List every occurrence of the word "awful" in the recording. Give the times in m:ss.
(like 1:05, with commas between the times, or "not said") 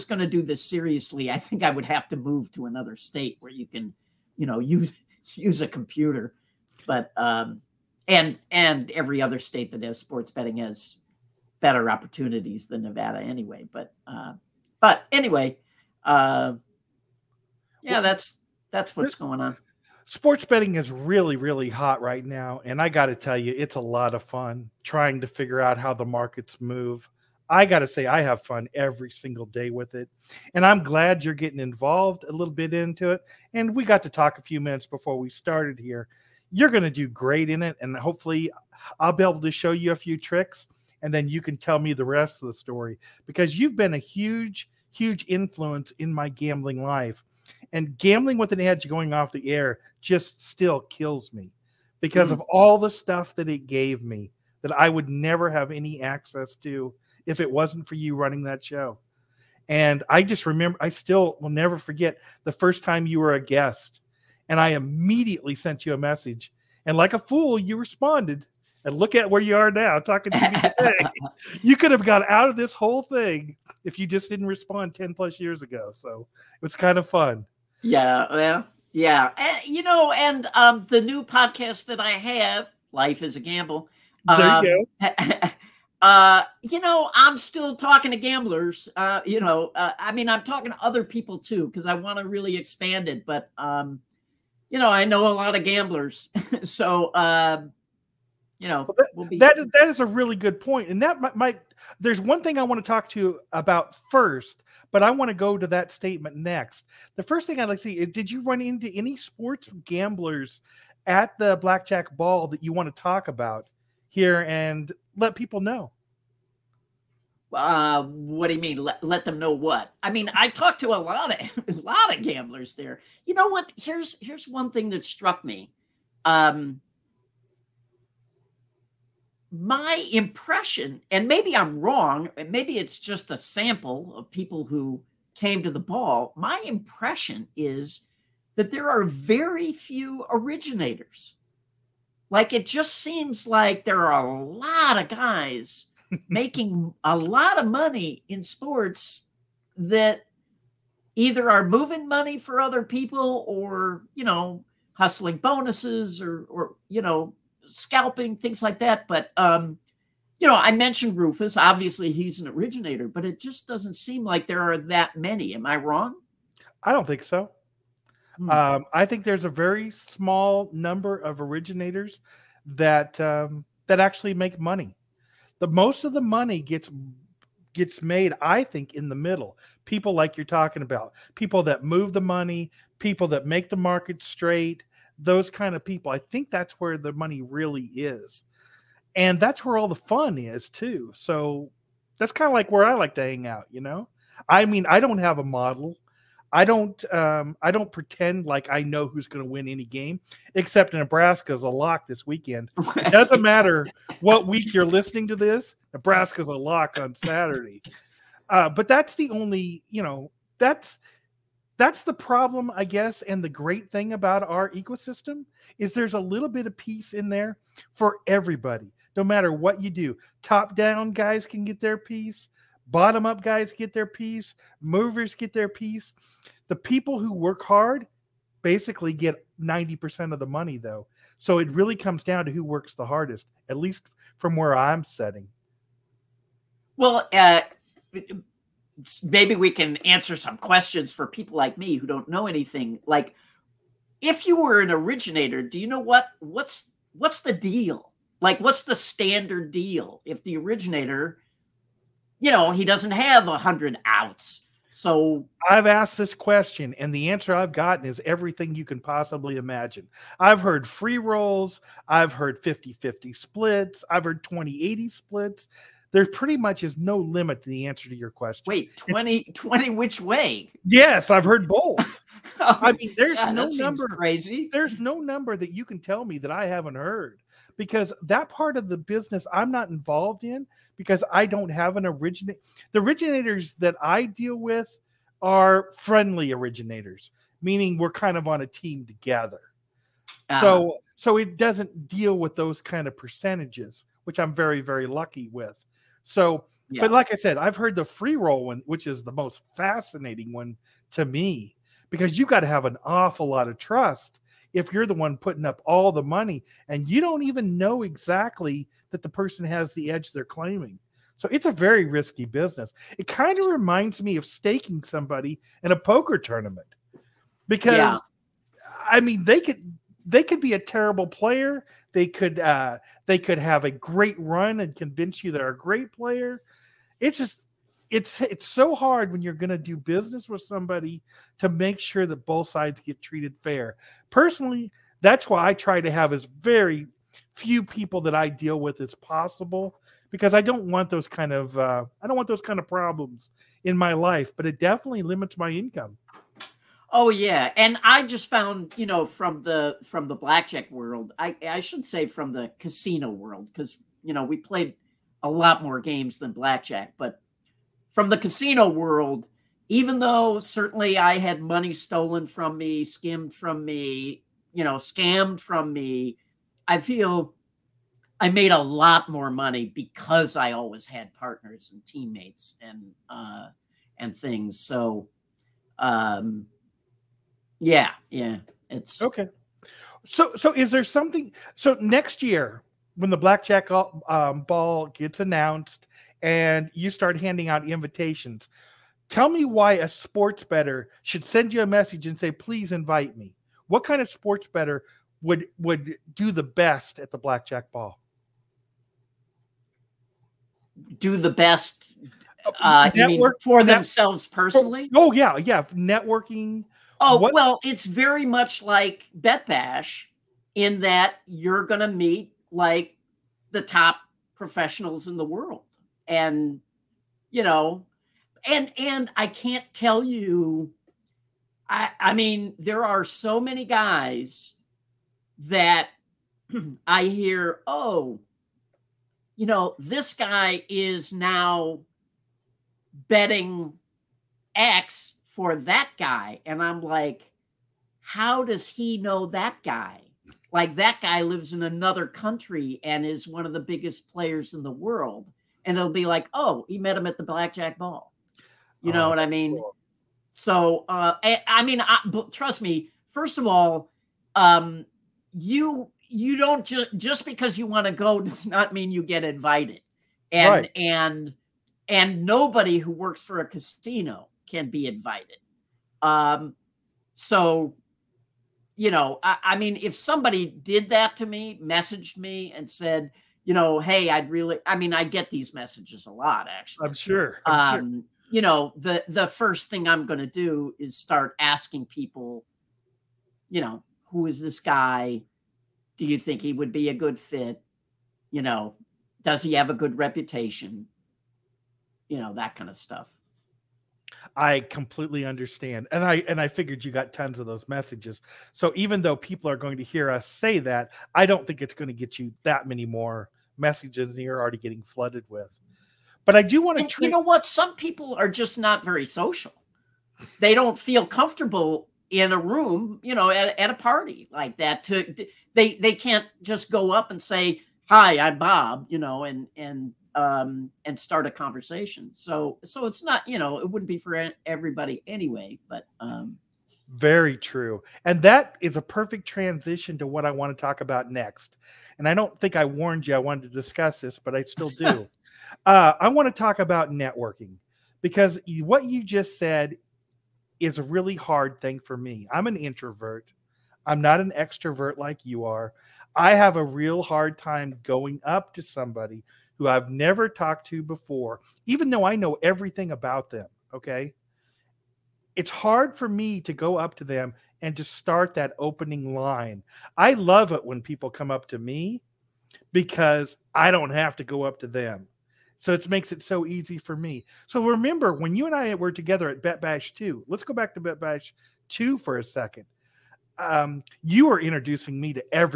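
5:03.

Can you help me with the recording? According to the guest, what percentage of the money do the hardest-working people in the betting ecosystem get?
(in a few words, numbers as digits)
90%.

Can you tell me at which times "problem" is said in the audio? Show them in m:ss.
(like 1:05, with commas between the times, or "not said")
3:32, 5:42.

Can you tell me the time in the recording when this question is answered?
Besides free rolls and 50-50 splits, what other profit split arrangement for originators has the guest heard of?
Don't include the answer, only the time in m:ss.
4:24.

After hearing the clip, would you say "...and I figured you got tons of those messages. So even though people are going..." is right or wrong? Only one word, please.
right.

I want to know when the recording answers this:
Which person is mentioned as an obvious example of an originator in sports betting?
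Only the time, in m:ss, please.
2:41.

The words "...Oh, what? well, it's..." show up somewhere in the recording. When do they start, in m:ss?
6:47.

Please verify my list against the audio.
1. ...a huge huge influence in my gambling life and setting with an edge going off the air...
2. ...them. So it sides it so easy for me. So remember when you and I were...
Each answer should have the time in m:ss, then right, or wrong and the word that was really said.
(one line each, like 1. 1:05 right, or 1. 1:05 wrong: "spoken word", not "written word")
1. 0:43 wrong: "gambling", not "setting"
2. 9:24 wrong: "makes", not "sides".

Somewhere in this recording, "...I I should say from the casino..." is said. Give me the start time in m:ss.
5:51.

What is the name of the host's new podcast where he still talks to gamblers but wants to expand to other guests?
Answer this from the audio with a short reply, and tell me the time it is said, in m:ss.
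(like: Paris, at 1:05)
Life is a Gamble, at 1:22.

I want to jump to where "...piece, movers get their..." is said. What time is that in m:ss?
3:44.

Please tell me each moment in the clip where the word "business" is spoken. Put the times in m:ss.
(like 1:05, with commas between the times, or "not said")
4:38, 5:12, 5:29.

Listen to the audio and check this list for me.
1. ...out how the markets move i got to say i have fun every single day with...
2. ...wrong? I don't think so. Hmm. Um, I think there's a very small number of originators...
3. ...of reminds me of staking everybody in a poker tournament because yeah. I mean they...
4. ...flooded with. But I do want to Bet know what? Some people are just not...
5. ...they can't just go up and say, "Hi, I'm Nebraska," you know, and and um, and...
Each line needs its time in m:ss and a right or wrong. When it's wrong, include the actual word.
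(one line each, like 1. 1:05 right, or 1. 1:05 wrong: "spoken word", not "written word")
1. 0:25 right
2. 2:45 right
3. 5:13 wrong: "somebody", not "everybody"
4. 8:25 wrong: "You", not "Bet"
5. 8:35 wrong: "Bob", not "Nebraska".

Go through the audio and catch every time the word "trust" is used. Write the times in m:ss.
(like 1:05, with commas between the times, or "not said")
5:03, 7:32.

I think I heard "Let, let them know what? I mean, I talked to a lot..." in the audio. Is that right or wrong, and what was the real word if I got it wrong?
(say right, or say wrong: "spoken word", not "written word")
right.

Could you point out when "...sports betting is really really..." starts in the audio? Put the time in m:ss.
0:20.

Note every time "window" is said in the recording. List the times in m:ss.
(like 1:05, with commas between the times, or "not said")
not said.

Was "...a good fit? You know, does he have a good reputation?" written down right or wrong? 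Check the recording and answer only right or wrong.
right.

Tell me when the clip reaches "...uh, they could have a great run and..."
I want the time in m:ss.
5:22.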